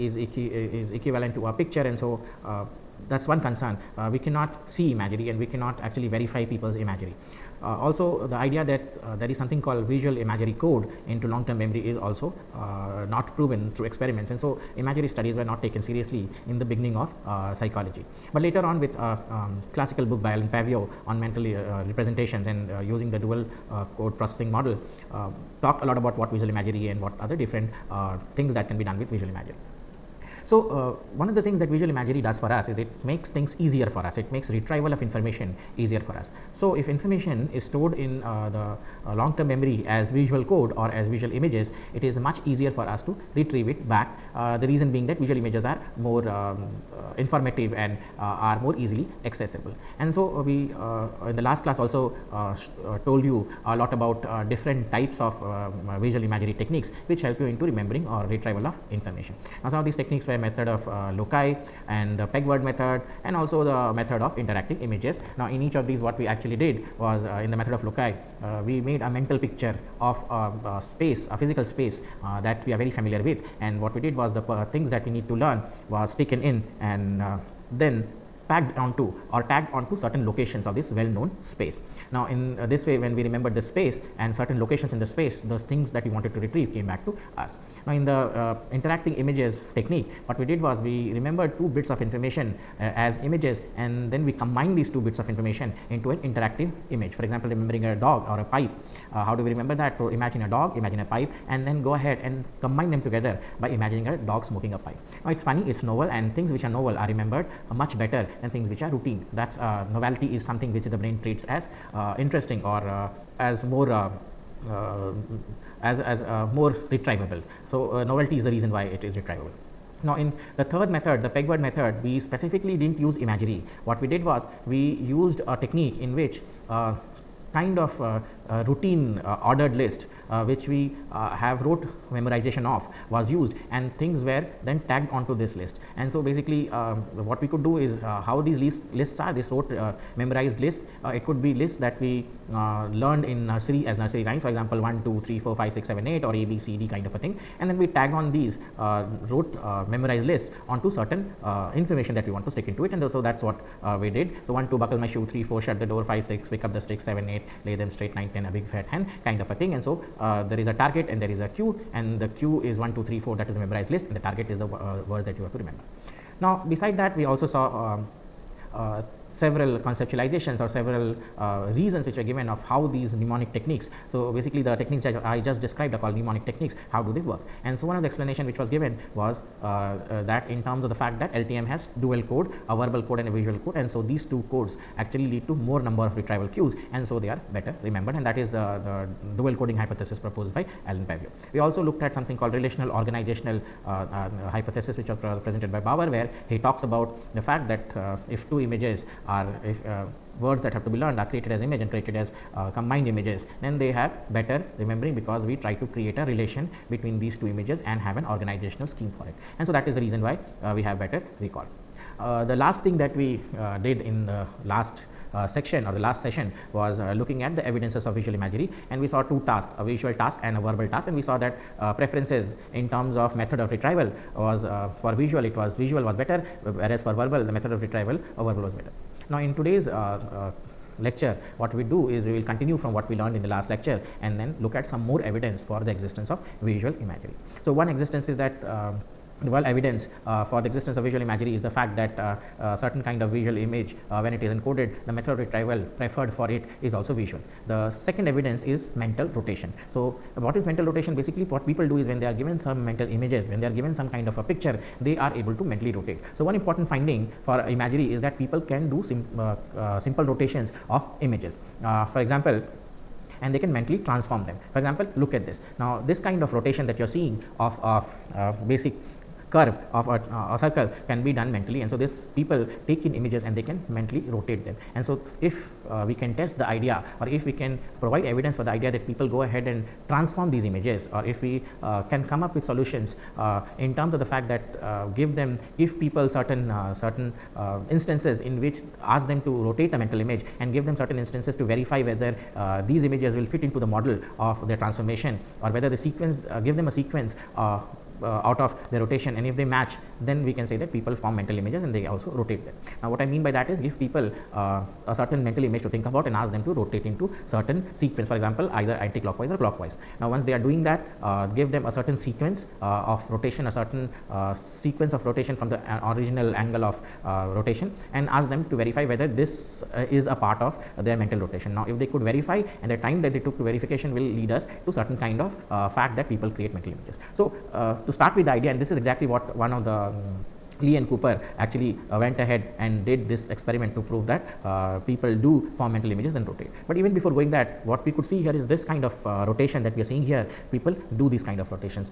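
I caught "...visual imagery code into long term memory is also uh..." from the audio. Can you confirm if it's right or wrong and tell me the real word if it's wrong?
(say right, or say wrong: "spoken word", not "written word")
right.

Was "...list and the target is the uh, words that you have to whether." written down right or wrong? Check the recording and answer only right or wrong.
wrong.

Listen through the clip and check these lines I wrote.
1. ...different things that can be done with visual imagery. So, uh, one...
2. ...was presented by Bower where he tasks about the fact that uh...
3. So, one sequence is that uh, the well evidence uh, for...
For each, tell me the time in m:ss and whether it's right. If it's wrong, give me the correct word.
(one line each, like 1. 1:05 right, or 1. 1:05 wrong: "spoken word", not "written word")
1. 0:27 right
2. 3:15 wrong: "talks", not "tasks"
3. 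3:57 wrong: "existence", not "sequence".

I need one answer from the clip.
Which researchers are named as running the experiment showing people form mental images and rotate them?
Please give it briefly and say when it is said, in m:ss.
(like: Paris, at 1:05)
Lee and Cooper, at 5:30.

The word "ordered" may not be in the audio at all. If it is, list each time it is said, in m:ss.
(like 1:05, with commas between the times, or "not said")
2:09.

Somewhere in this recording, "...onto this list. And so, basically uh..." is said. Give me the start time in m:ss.
2:15.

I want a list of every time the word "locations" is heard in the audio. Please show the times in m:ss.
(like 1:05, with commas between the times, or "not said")
1:20, 1:24.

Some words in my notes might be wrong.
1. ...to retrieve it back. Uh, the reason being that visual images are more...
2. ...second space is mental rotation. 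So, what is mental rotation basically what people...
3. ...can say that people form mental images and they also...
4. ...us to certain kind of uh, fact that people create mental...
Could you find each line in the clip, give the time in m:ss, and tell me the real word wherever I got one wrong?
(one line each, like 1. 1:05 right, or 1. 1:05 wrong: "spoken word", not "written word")
1. 0:43 right
2. 4:07 wrong: "evidence", not "space"
3. 5:00 right
4. 5:24 right.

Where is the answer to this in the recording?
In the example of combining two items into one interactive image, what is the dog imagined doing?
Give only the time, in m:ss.
1:44.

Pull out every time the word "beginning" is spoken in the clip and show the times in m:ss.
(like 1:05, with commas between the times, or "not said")
0:16.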